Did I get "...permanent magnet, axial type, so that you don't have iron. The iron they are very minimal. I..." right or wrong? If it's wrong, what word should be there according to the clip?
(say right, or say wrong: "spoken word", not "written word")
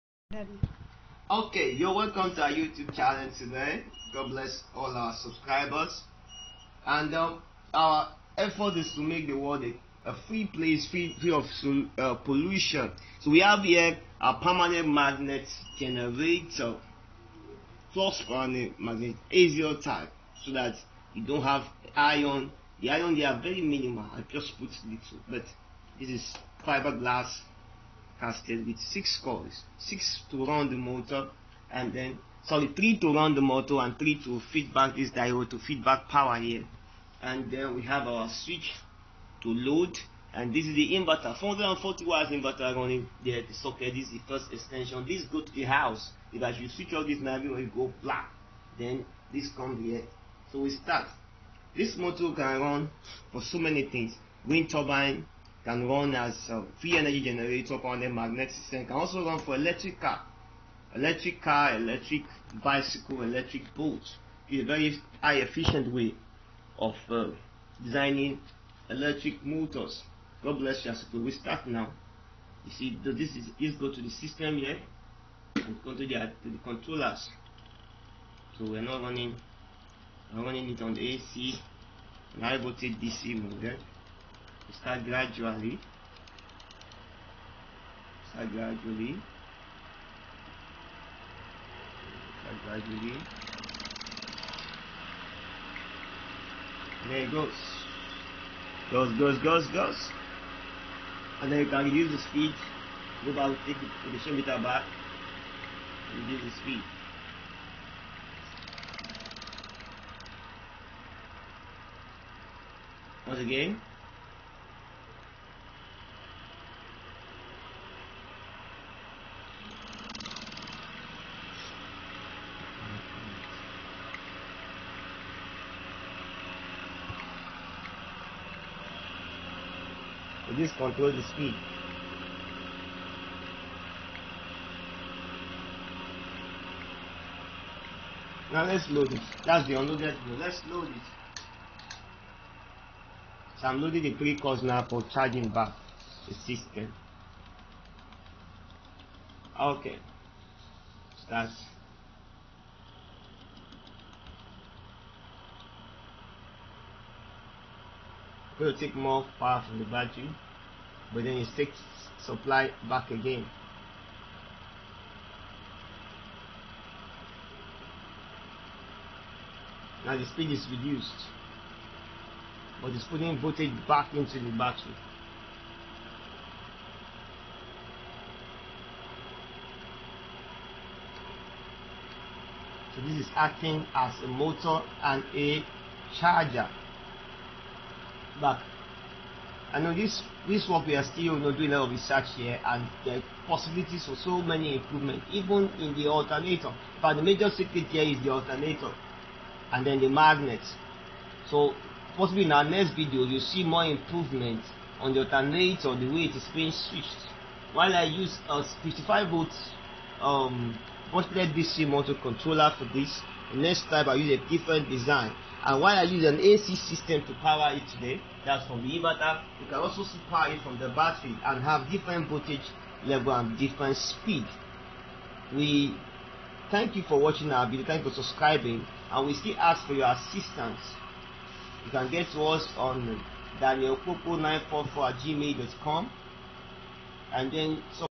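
right.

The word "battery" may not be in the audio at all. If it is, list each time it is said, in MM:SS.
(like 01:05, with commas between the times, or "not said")
02:39, 02:54, 03:40.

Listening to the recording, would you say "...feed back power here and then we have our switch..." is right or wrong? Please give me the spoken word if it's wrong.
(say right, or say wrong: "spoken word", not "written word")
right.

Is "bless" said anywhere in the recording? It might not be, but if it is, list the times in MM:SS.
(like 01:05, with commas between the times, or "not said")
00:04, 01:10.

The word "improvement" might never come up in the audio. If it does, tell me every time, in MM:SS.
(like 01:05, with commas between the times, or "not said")
03:14, 03:23.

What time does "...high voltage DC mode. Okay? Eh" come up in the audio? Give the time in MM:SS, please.
01:22.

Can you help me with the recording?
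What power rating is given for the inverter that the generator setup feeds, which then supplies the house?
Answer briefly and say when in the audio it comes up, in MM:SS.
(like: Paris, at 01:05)
440 watts, at 00:41.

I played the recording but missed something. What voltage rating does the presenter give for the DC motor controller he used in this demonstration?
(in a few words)
55 volt.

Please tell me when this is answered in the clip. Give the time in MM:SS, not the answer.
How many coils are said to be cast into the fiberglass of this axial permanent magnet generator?
00:28.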